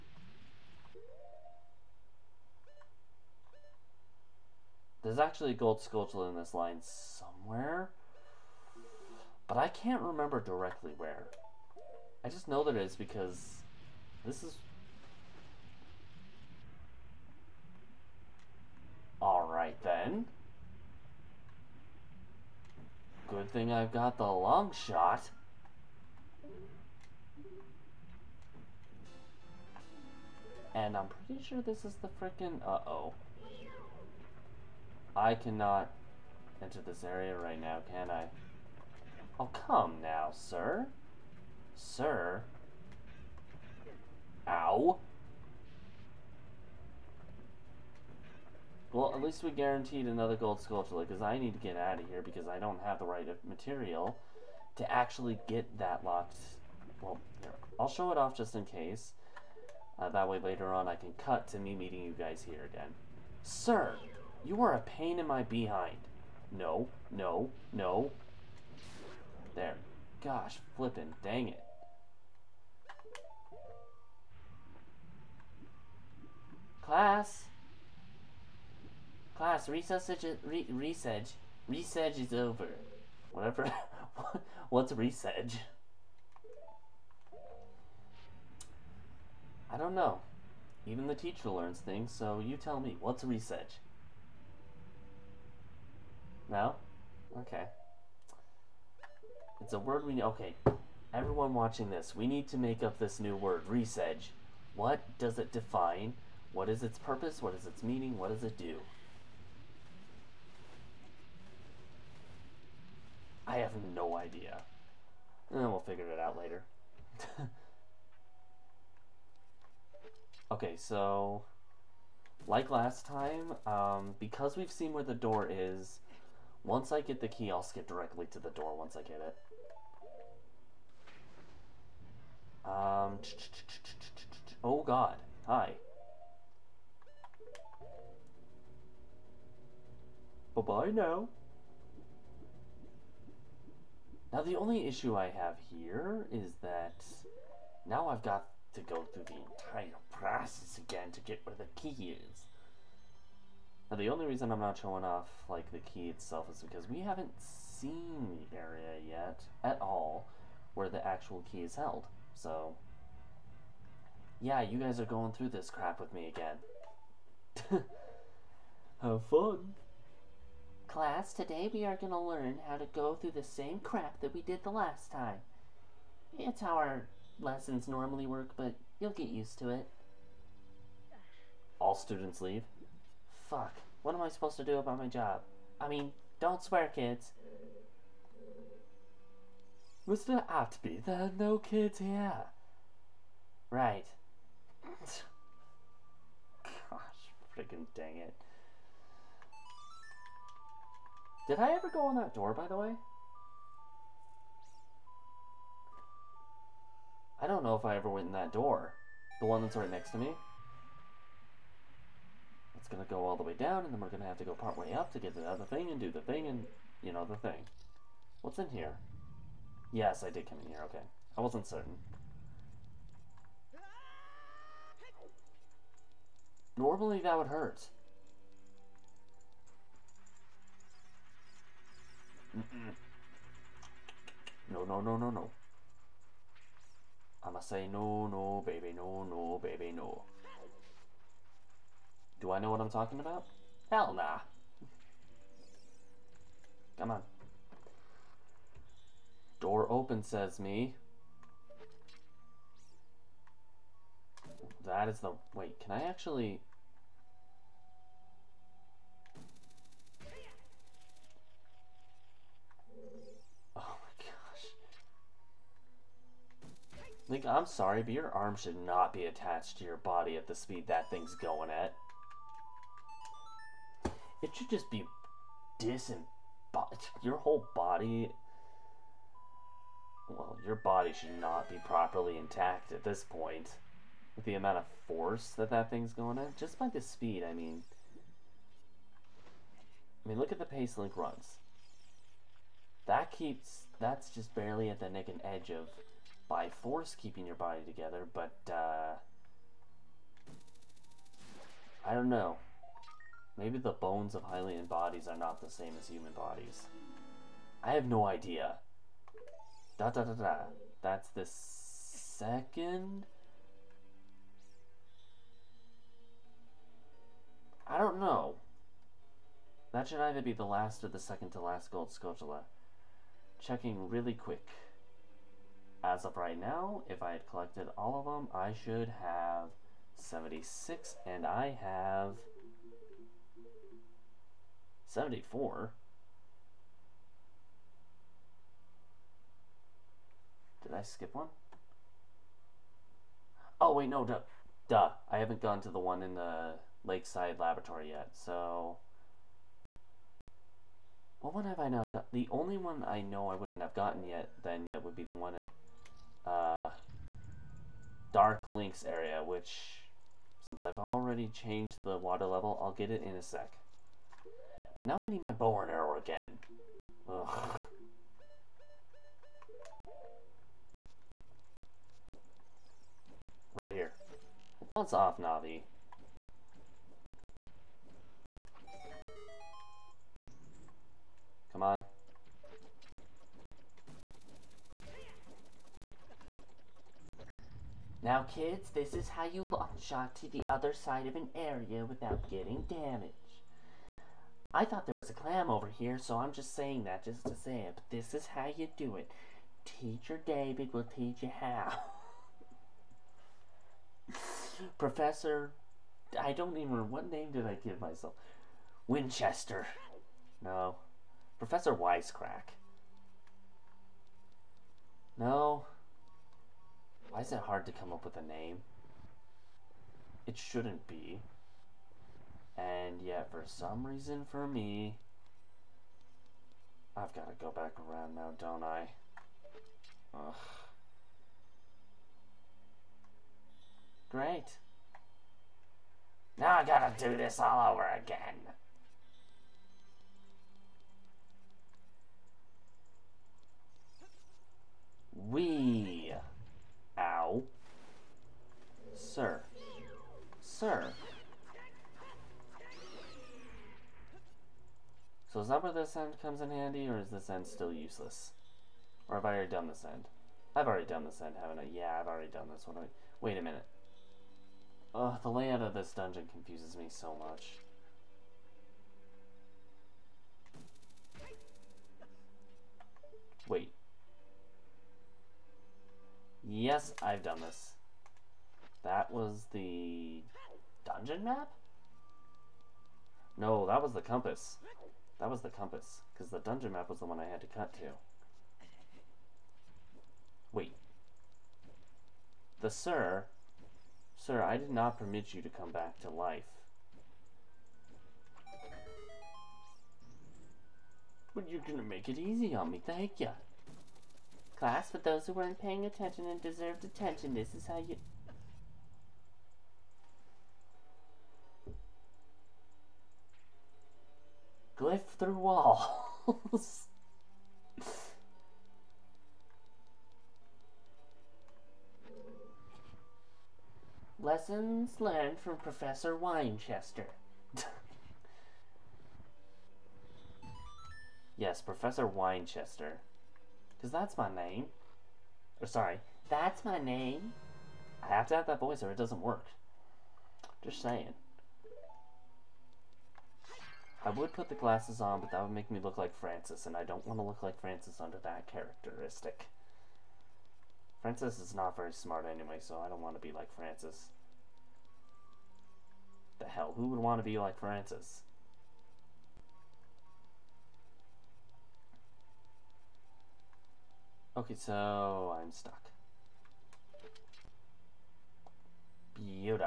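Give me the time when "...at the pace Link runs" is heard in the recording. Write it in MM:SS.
04:50.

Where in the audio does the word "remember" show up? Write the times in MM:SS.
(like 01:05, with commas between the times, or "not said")
00:10, 06:46.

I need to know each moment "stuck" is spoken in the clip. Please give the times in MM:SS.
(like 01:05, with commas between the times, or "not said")
09:25.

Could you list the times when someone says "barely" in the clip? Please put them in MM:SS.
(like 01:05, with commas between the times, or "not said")
04:54.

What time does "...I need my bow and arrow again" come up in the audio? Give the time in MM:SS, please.
06:05.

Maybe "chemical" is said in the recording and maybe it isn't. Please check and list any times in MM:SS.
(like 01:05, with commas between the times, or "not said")
not said.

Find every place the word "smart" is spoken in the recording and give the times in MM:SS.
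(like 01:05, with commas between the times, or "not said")
09:12.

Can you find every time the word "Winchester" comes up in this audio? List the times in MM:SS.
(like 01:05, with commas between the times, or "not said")
06:49, 08:46, 08:52.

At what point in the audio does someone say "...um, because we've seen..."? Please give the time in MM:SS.
02:03.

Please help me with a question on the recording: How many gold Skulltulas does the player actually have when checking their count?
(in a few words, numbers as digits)
74.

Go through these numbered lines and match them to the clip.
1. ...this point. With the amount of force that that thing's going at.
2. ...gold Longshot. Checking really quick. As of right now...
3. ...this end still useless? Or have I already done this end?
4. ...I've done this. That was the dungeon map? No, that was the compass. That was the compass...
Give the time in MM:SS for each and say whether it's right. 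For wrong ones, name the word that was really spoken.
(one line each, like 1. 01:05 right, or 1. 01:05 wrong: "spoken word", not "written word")
1. 04:43 right
2. 05:21 wrong: "Skulltula", not "Longshot"
3. 07:37 right
4. 07:57 right.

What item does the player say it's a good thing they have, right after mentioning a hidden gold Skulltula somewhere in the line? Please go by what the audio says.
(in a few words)
long shot.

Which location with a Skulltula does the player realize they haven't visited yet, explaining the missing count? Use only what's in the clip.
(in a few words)
Lakeside Laboratory.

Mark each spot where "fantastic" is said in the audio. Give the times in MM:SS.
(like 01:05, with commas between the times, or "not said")
not said.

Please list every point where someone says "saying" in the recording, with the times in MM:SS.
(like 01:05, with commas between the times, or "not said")
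06:36, 09:01.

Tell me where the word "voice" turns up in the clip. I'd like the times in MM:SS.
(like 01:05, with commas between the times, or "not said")
08:58.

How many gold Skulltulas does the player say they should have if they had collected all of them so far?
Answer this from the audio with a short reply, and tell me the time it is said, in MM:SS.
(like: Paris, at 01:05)
76, at 05:30.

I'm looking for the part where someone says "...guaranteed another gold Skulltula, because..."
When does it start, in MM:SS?
00:49.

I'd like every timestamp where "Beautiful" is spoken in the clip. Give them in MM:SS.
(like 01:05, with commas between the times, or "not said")
09:29.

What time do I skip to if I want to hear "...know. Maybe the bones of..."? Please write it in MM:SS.
05:02.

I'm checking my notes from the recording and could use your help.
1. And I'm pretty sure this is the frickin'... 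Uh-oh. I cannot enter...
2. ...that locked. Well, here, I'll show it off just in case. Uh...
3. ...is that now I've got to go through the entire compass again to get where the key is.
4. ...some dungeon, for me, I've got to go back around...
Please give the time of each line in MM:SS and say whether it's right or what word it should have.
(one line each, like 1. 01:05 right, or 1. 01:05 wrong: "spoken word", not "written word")
1. 00:30 right
2. 00:55 right
3. 02:26 wrong: "process", not "compass"
4. 07:03 wrong: "reason", not "dungeon".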